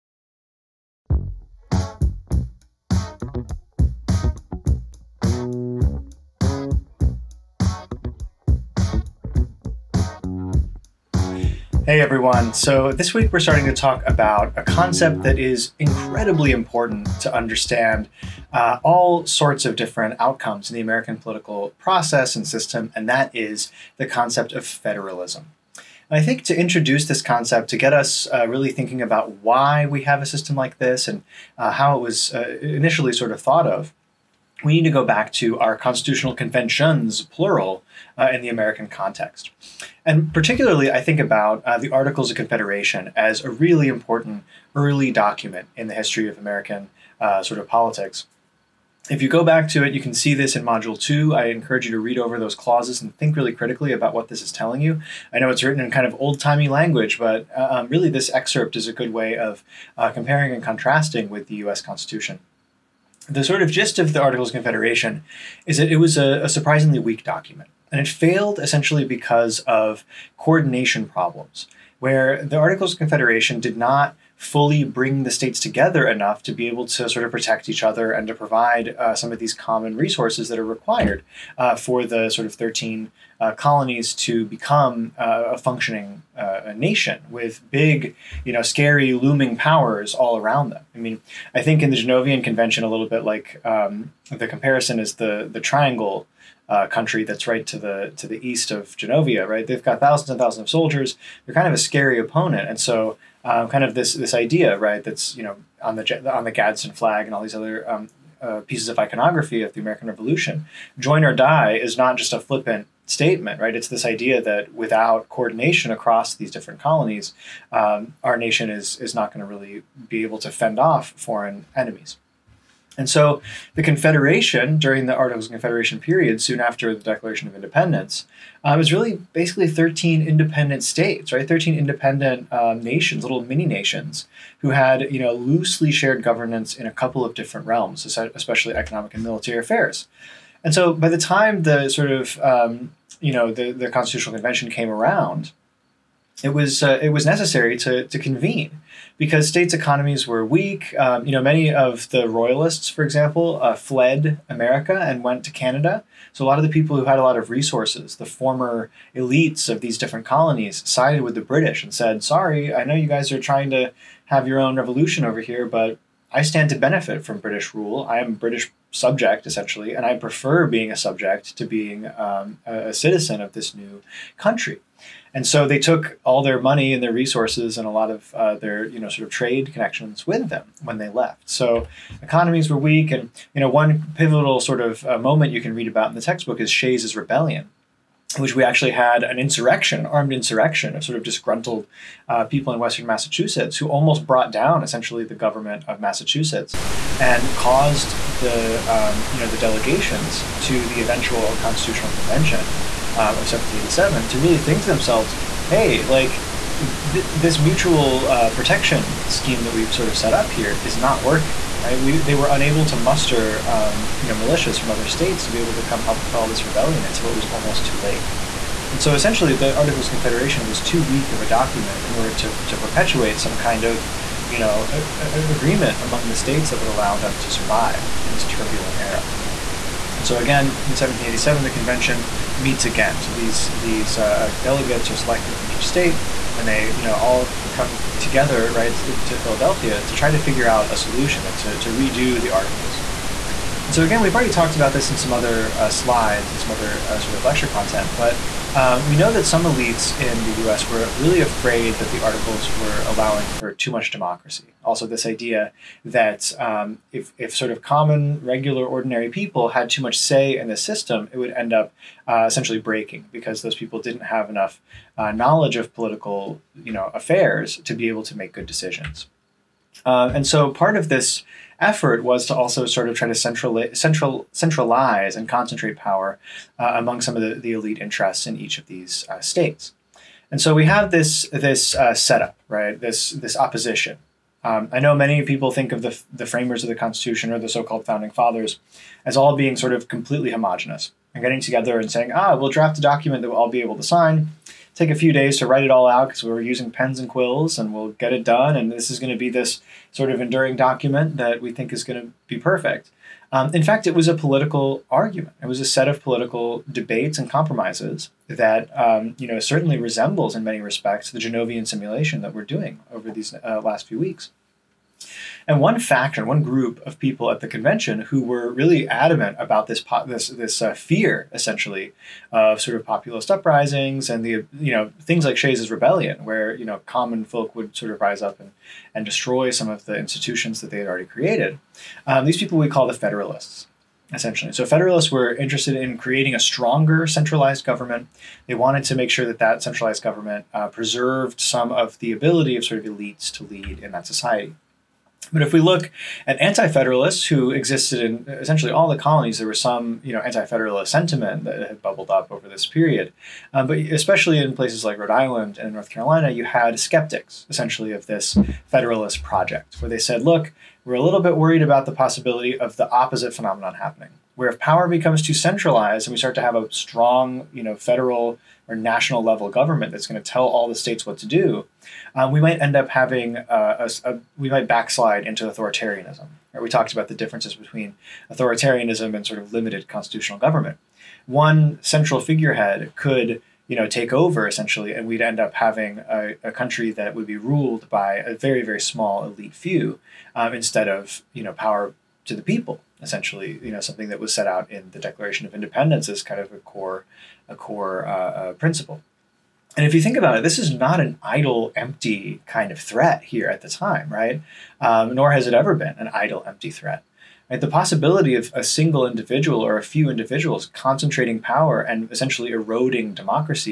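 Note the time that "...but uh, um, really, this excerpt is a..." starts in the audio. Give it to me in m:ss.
0:57.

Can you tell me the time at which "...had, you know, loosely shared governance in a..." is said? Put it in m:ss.
2:14.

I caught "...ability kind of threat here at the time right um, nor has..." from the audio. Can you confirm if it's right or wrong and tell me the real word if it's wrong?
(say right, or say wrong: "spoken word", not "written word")
wrong: "empty", not "ability".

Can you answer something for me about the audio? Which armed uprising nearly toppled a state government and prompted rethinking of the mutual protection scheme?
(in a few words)
Shays's rebellion.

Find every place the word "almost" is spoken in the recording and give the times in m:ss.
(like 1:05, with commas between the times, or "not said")
3:13, 3:37.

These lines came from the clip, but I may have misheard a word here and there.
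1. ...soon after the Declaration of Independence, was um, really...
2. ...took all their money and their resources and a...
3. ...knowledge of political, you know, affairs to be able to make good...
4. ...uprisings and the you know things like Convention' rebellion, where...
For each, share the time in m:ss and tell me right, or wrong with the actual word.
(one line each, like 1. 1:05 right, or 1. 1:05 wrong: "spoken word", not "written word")
1. 2:06 right
2. 2:55 right
3. 4:25 right
4. 5:23 wrong: "Shays", not "Convention".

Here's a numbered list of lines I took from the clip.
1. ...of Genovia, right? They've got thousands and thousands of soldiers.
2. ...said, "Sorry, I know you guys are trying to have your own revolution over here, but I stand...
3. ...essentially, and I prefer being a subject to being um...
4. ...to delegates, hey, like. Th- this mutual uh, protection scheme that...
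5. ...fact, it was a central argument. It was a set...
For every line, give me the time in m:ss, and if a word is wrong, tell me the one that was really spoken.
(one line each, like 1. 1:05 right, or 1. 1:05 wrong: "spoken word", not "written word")
1. 1:38 right
2. 2:41 right
3. 2:49 right
4. 3:24 wrong: "themselves", not "delegates"
5. 5:03 wrong: "political", not "central".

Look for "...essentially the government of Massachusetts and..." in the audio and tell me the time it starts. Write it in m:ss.
3:14.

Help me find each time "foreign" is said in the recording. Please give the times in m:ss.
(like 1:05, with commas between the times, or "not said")
2:01.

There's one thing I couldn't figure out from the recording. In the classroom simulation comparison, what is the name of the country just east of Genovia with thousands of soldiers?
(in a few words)
The triangle.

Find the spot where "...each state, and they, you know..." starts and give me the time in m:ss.
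3:55.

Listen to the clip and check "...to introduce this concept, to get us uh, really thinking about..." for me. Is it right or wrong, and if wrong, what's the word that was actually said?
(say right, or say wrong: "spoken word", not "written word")
right.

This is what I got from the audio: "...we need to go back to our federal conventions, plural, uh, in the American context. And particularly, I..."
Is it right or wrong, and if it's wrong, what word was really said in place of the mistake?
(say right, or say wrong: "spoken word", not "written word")
wrong: "constitutional", not "federal".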